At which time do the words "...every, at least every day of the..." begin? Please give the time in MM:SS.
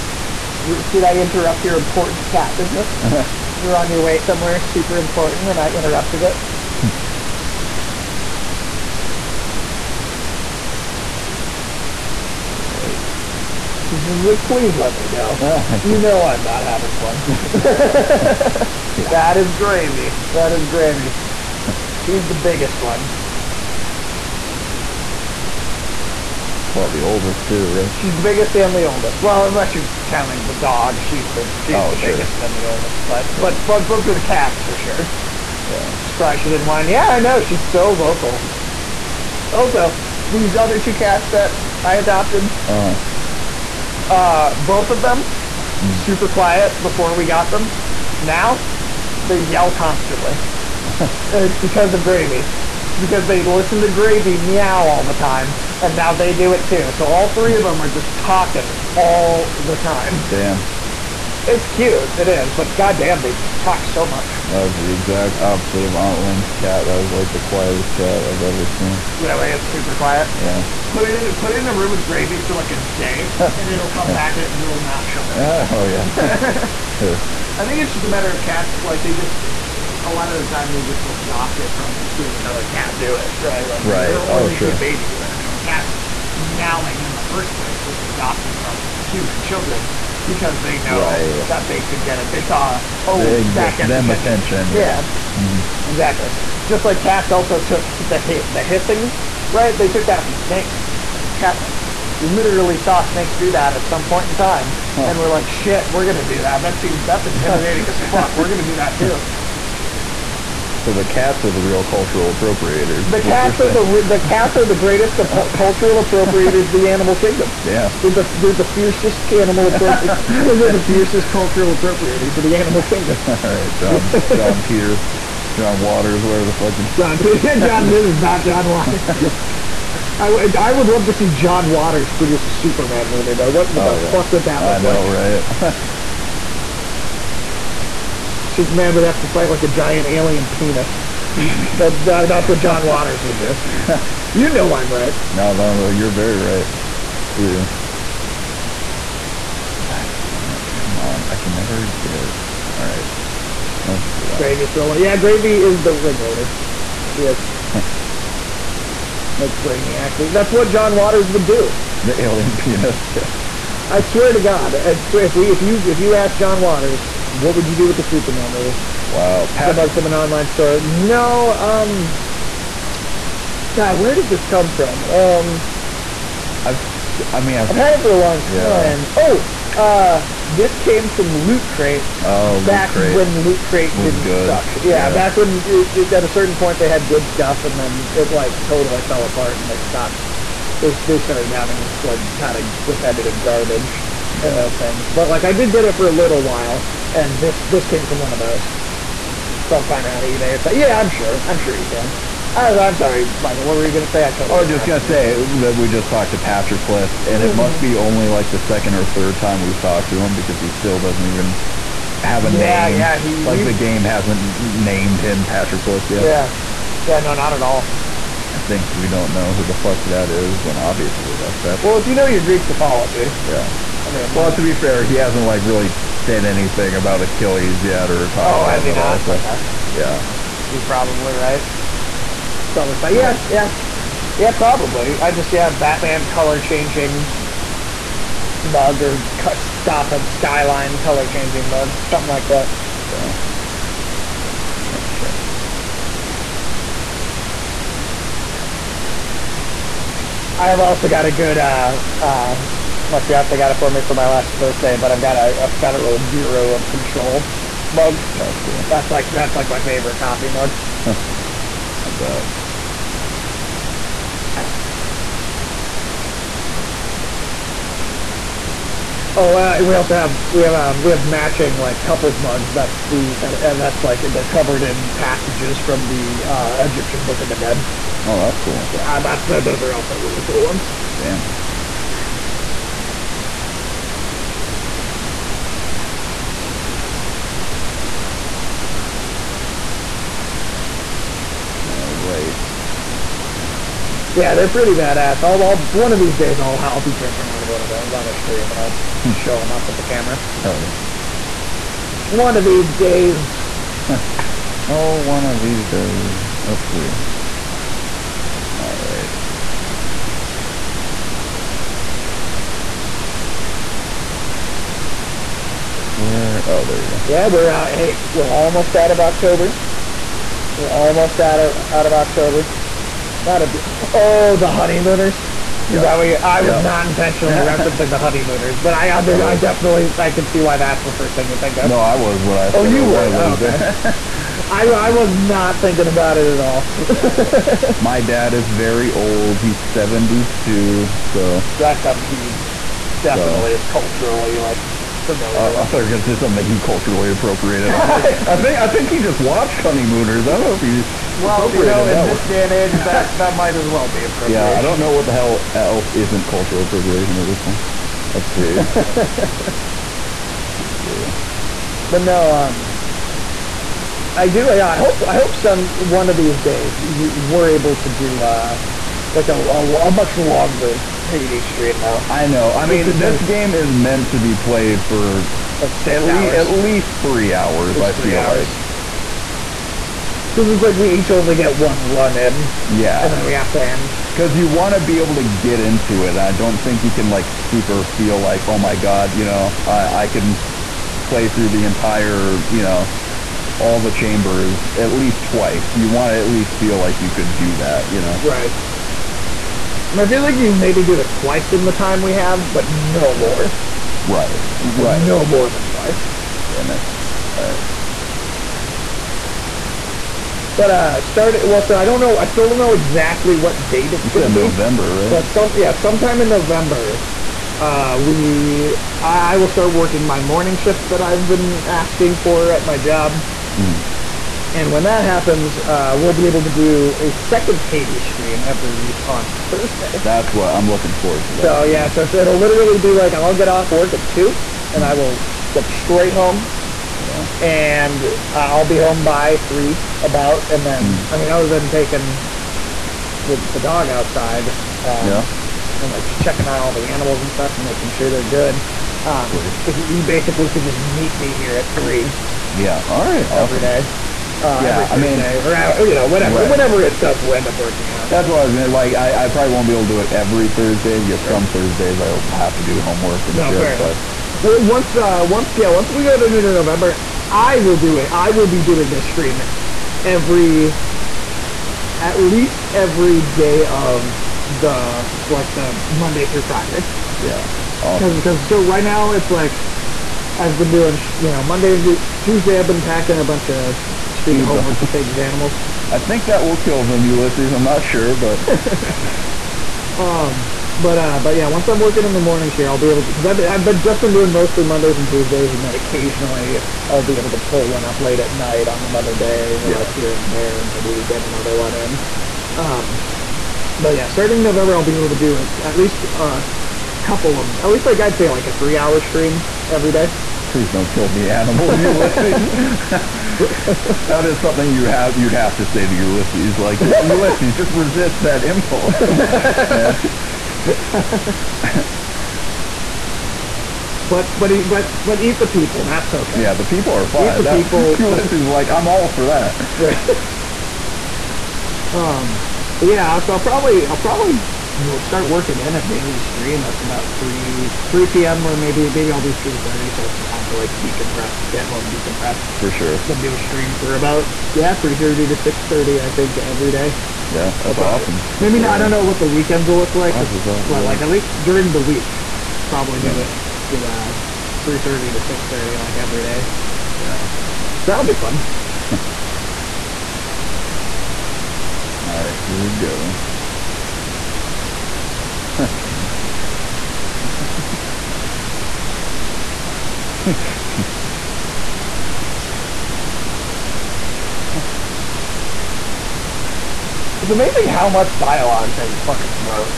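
07:50.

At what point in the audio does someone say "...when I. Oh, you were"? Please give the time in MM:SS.
05:32.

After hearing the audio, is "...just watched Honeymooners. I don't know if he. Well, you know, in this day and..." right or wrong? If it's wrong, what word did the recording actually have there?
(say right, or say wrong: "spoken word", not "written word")
right.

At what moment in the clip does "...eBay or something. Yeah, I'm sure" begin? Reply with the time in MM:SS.
03:20.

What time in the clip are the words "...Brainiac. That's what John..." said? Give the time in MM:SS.
02:39.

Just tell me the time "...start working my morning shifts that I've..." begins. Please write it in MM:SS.
06:59.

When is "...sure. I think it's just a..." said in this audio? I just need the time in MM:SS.
01:16.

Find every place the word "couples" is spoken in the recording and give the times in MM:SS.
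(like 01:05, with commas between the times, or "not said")
04:32, 08:27.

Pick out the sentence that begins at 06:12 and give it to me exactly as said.
I mean, this, this game is meant to be played for like six at, hours.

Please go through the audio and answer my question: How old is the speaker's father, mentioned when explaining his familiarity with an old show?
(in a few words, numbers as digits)
72.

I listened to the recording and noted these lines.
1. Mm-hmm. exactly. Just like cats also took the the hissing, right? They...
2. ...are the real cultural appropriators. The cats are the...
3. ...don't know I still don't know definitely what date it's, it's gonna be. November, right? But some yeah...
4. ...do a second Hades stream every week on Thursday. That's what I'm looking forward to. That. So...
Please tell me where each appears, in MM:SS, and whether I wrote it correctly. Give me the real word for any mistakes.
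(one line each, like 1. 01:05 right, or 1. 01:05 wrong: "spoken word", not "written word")
1. 01:35 right
2. 01:51 right
3. 06:52 wrong: "exactly", not "definitely"
4. 07:06 right.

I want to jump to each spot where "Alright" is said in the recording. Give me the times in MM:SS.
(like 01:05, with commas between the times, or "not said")
00:12, 05:08, 06:47.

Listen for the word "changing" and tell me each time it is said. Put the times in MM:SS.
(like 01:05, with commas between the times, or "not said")
03:56, 04:01.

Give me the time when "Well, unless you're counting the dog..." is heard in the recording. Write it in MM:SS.
00:29.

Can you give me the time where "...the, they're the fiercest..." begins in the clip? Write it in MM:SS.
01:58.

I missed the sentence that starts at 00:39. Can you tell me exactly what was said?
Also, these other two cats that I adopted.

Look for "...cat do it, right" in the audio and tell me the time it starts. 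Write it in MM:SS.
01:22.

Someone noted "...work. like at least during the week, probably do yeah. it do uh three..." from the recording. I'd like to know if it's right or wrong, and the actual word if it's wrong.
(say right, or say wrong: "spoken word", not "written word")
right.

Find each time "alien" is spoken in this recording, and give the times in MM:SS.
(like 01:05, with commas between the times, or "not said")
02:20, 02:42.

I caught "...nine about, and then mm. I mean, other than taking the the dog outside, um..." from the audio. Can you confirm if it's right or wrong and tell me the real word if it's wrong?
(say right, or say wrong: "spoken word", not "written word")
wrong: "three", not "nine".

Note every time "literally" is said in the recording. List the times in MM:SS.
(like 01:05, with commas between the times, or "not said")
01:42, 07:12.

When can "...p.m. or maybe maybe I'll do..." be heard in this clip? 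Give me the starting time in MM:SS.
08:58.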